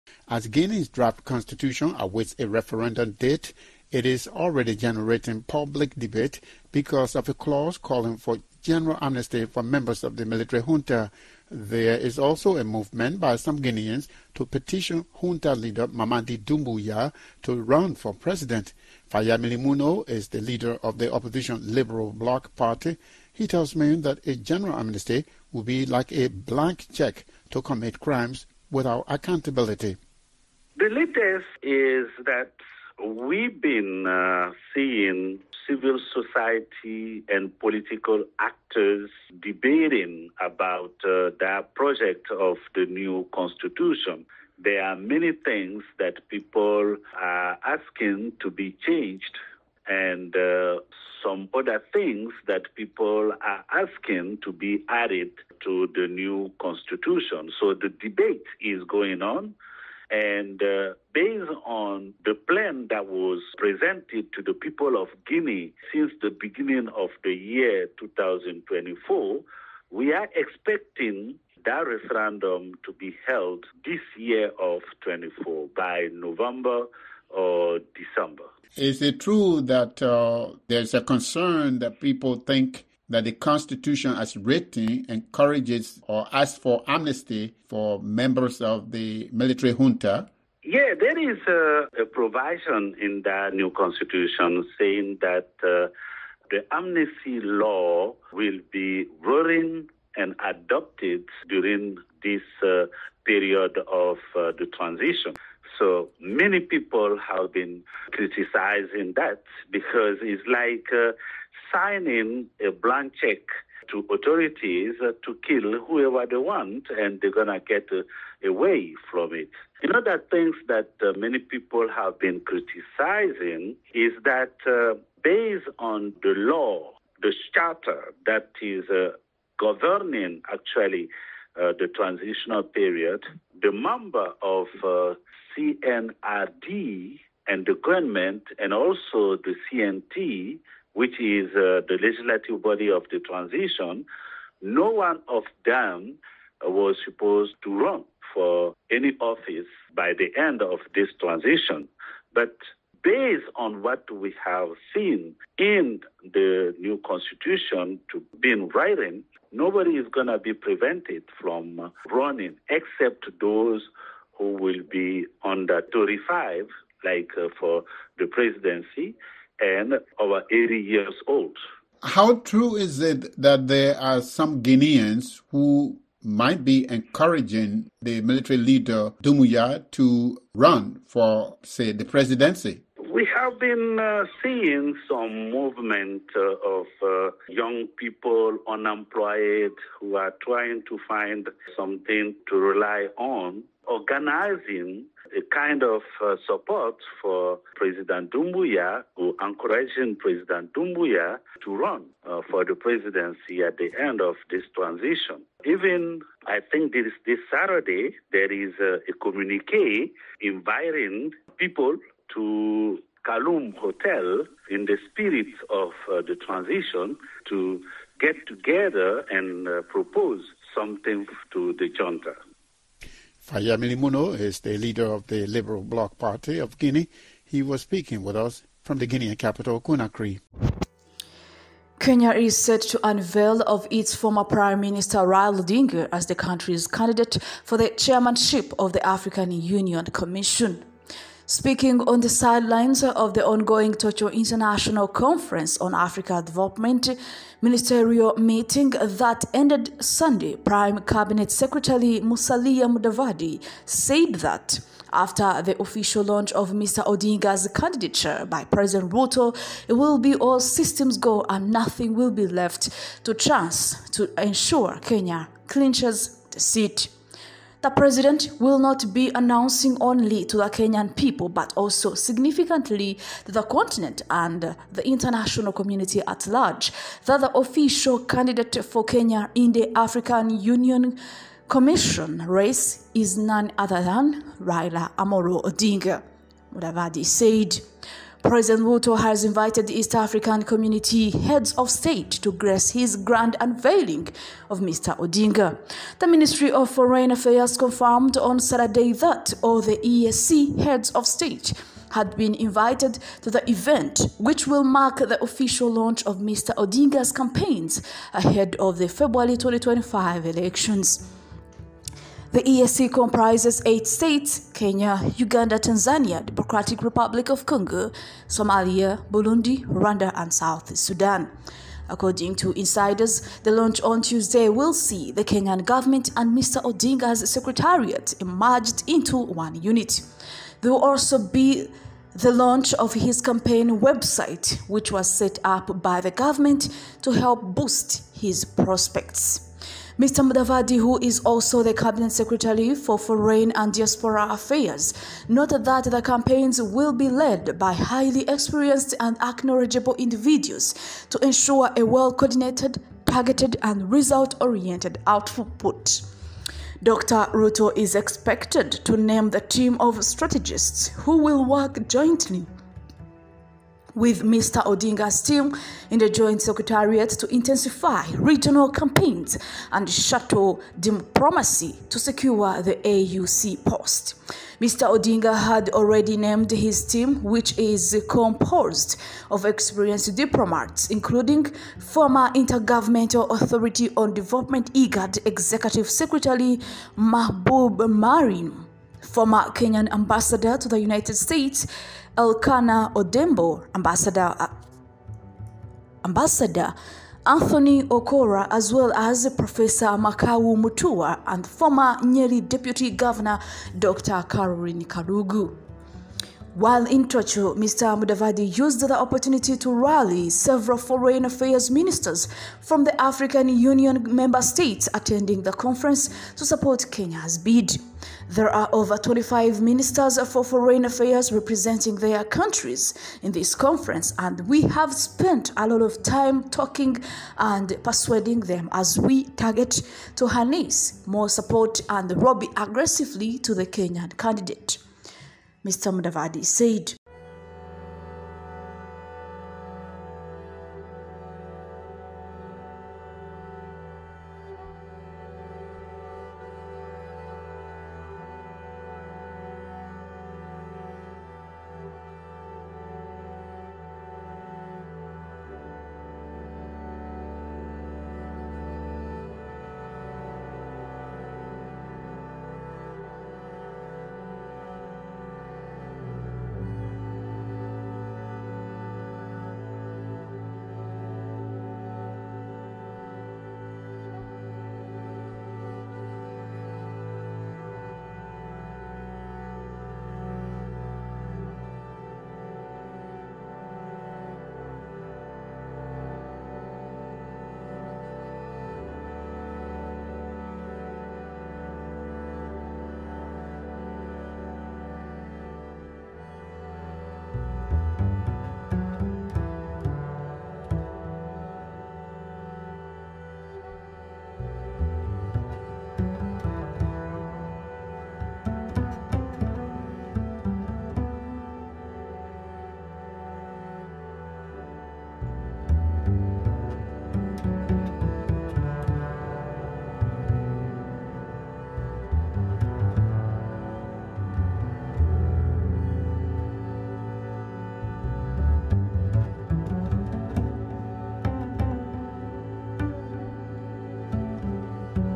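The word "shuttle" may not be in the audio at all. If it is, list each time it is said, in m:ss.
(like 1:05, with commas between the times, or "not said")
6:10.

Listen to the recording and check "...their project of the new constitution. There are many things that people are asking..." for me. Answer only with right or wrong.
right.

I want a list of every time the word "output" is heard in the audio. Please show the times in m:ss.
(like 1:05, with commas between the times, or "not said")
5:55.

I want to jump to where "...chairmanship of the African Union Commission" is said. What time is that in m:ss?
3:57.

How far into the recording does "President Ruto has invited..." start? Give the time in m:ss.
4:48.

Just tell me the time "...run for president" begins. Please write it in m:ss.
0:17.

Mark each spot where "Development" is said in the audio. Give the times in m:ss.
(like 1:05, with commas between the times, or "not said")
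4:06, 6:24.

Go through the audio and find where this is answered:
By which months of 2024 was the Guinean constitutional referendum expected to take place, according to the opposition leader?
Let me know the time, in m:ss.
1:16.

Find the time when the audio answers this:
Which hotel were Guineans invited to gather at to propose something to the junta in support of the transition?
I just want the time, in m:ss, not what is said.
3:33.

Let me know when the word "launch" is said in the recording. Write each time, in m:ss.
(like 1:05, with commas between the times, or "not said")
4:16, 5:05, 5:23, 5:32.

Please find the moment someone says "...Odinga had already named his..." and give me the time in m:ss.
6:15.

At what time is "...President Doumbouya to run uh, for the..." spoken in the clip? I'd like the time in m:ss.
3:20.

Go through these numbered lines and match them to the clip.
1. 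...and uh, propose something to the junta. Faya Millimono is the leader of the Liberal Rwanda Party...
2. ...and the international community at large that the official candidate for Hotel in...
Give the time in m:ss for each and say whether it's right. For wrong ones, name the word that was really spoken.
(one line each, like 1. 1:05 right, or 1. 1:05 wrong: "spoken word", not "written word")
1. 3:39 wrong: "Bloc", not "Rwanda"
2. 4:34 wrong: "Kenya", not "Hotel".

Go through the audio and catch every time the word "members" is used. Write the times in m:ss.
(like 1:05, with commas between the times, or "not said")
0:09, 1:28, 2:13, 6:54.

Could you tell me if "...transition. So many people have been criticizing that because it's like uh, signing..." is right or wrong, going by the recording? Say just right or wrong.
right.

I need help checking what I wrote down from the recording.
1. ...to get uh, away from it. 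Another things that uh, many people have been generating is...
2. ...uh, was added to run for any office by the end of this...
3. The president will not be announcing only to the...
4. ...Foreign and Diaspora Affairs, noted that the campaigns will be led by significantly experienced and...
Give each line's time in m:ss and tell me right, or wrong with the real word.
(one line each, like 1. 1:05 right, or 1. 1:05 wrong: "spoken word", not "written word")
1. 1:57 wrong: "criticizing", not "generating"
2. 2:26 wrong: "supposed", not "added"
3. 4:27 right
4. 5:43 wrong: "highly", not "significantly".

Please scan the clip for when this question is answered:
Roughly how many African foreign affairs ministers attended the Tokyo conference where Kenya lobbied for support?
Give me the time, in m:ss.
6:58.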